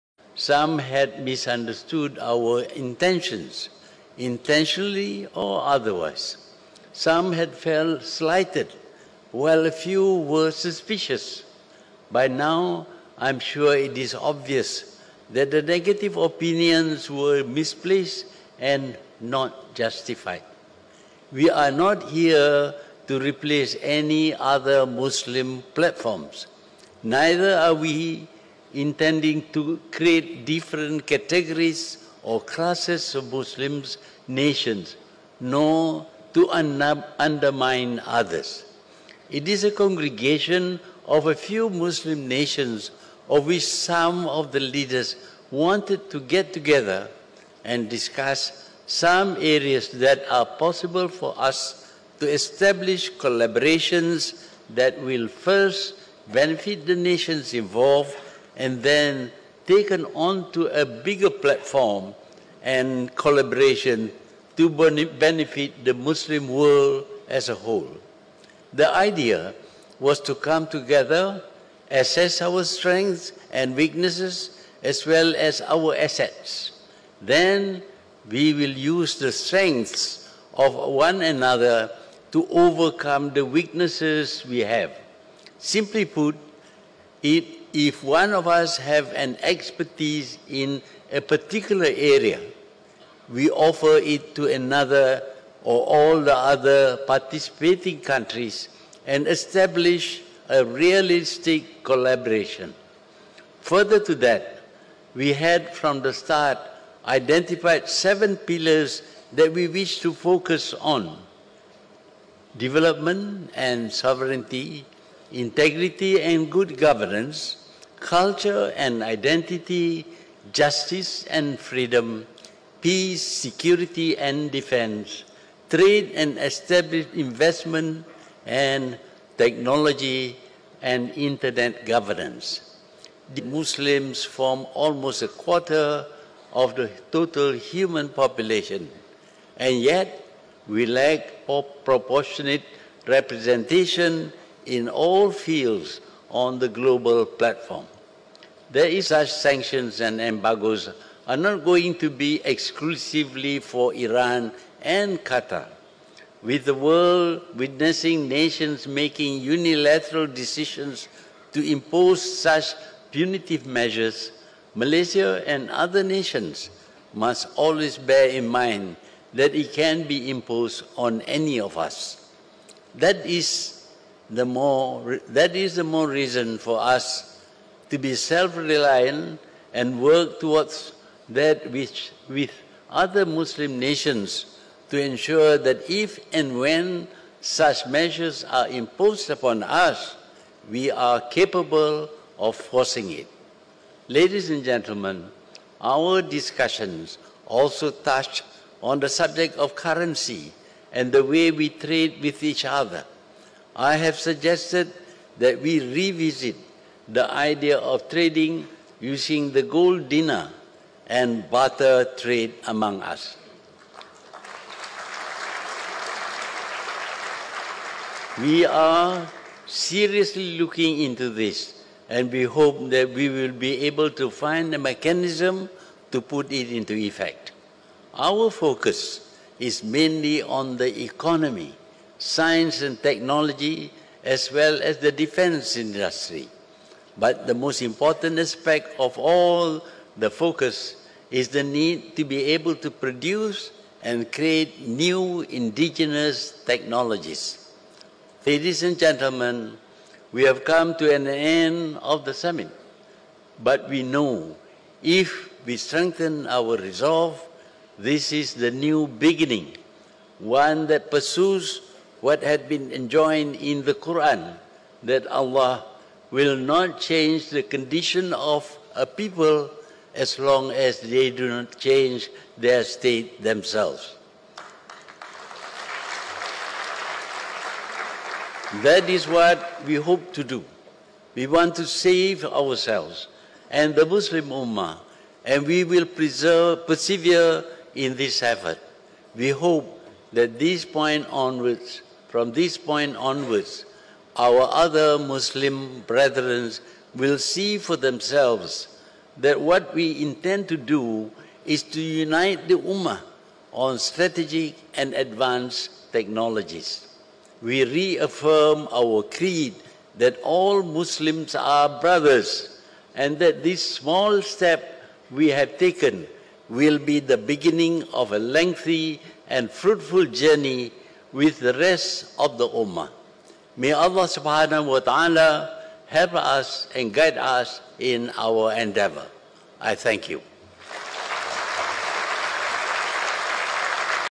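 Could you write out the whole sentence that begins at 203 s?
I have suggested that we revisit the idea of trading using the gold dinar and barter trade among us.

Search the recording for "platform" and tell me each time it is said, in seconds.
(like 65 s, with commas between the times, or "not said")
25 s, 61 s, 147 s.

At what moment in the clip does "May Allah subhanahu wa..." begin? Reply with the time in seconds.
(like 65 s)
323 s.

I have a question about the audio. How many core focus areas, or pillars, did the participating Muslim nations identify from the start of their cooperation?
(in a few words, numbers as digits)
7.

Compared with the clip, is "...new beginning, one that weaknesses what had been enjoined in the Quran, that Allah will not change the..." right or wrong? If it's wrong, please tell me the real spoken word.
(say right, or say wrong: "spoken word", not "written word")
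wrong: "pursues", not "weaknesses".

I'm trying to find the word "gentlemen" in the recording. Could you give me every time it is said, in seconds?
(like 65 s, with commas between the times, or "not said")
194 s, 248 s.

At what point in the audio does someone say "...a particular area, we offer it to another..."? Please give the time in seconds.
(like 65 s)
91 s.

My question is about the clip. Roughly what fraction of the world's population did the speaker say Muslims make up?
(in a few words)
a quarter.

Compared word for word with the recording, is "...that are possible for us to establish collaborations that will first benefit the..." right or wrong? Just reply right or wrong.
right.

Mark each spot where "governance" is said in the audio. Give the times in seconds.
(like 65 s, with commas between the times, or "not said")
116 s, 131 s.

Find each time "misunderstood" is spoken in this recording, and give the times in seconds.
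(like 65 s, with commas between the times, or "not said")
1 s.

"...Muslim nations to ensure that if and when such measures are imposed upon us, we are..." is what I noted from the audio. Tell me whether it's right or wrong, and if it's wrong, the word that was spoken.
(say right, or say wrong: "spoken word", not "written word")
right.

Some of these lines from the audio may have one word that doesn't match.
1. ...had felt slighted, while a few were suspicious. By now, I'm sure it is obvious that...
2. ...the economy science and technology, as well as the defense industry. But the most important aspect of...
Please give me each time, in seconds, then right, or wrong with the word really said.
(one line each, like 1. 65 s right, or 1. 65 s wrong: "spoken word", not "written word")
1. 7 s right
2. 230 s right.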